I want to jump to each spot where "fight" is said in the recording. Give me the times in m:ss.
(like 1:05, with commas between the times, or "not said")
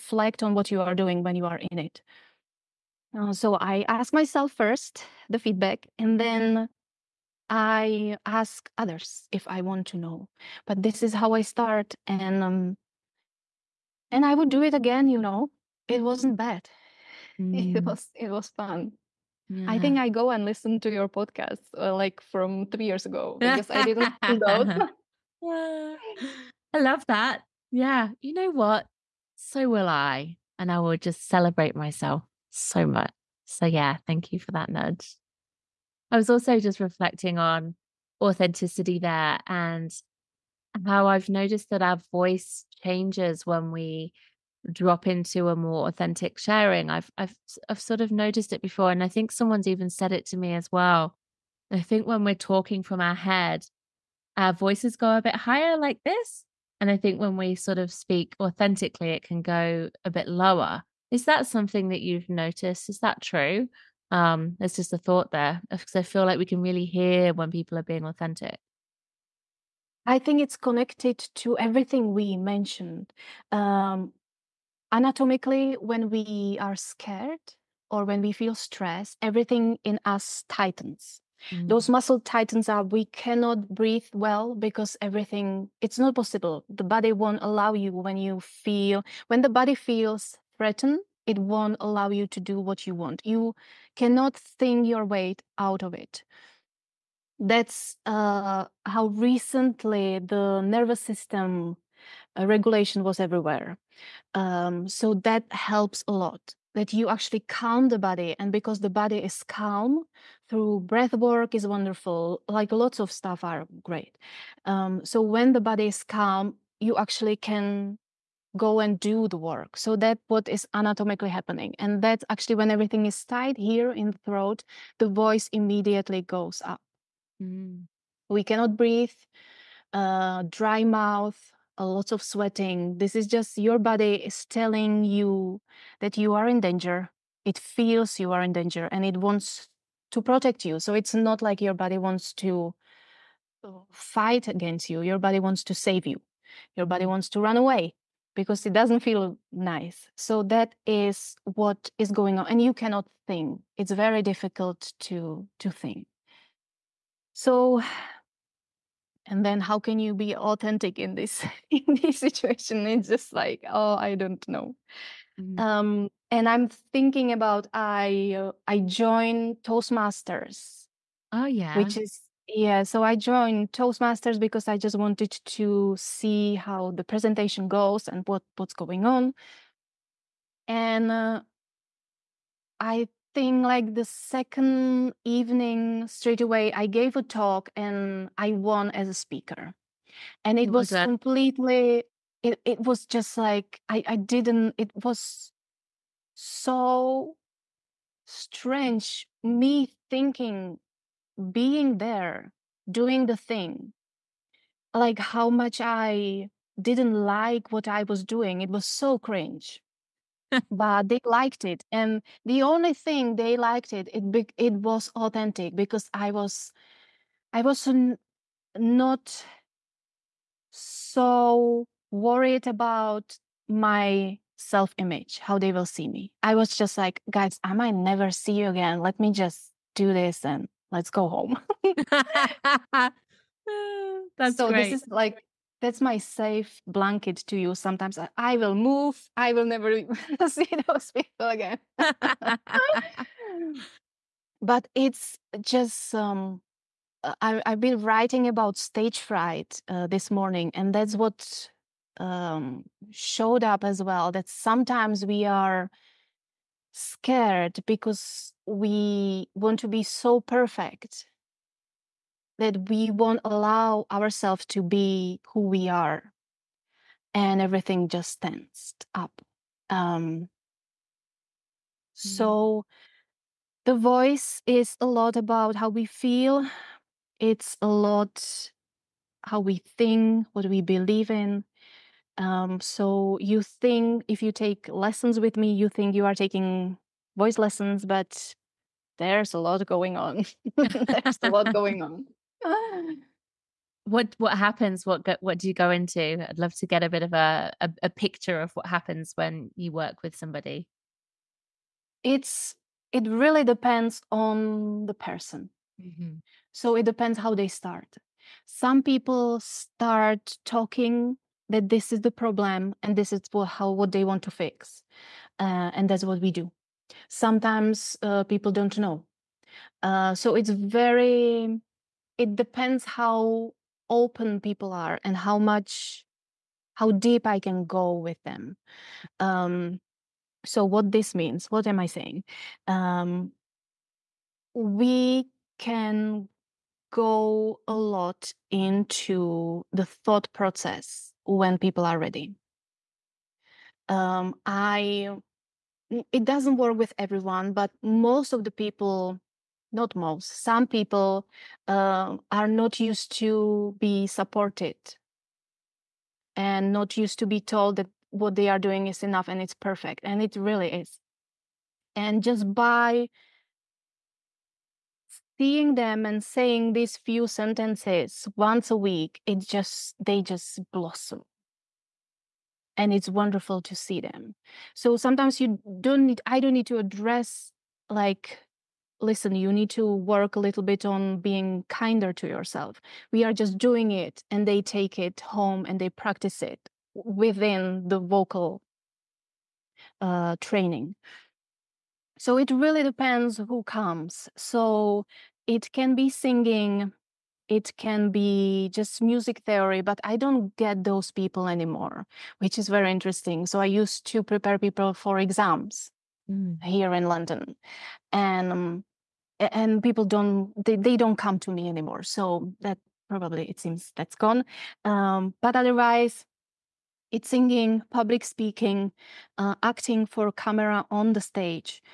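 2:23.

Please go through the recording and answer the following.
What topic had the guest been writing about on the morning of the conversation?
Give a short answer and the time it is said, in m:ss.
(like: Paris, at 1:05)
Stage fright, at 4:08.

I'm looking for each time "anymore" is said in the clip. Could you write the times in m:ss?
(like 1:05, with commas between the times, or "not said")
6:41, 6:51.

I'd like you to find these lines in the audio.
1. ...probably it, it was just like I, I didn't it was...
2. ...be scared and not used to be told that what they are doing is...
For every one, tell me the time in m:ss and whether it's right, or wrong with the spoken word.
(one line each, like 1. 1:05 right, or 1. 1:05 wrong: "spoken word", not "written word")
1. 3:11 wrong: "completely", not "probably"
2. 5:53 wrong: "supported", not "scared".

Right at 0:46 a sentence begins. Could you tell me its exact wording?
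I've I've I've sort of noticed it before and I think someone's even said it to me as well.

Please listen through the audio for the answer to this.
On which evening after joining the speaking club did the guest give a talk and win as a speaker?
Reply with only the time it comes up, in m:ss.
3:04.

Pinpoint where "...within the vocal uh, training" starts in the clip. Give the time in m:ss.
6:27.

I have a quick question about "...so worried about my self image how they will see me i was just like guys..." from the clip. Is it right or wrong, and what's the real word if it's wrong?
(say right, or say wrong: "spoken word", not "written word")
right.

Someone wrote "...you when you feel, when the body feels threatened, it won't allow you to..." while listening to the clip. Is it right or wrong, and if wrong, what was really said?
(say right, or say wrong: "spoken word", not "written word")
right.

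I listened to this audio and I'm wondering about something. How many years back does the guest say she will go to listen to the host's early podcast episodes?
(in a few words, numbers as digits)
3 years.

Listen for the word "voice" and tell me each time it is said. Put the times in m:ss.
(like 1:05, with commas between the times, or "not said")
0:42, 0:54, 2:05, 4:33, 4:47.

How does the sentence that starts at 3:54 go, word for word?
this is like that's my safe blanket to you.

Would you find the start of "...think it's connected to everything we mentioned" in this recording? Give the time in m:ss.
1:10.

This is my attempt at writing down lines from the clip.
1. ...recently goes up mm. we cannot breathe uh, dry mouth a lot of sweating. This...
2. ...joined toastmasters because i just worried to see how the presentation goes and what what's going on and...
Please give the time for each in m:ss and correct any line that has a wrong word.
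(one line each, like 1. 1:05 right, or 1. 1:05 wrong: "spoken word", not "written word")
1. 2:05 wrong: "immediately", not "recently"
2. 2:53 wrong: "wanted", not "worried".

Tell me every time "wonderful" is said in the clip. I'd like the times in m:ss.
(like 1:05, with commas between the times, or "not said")
1:51, 6:13.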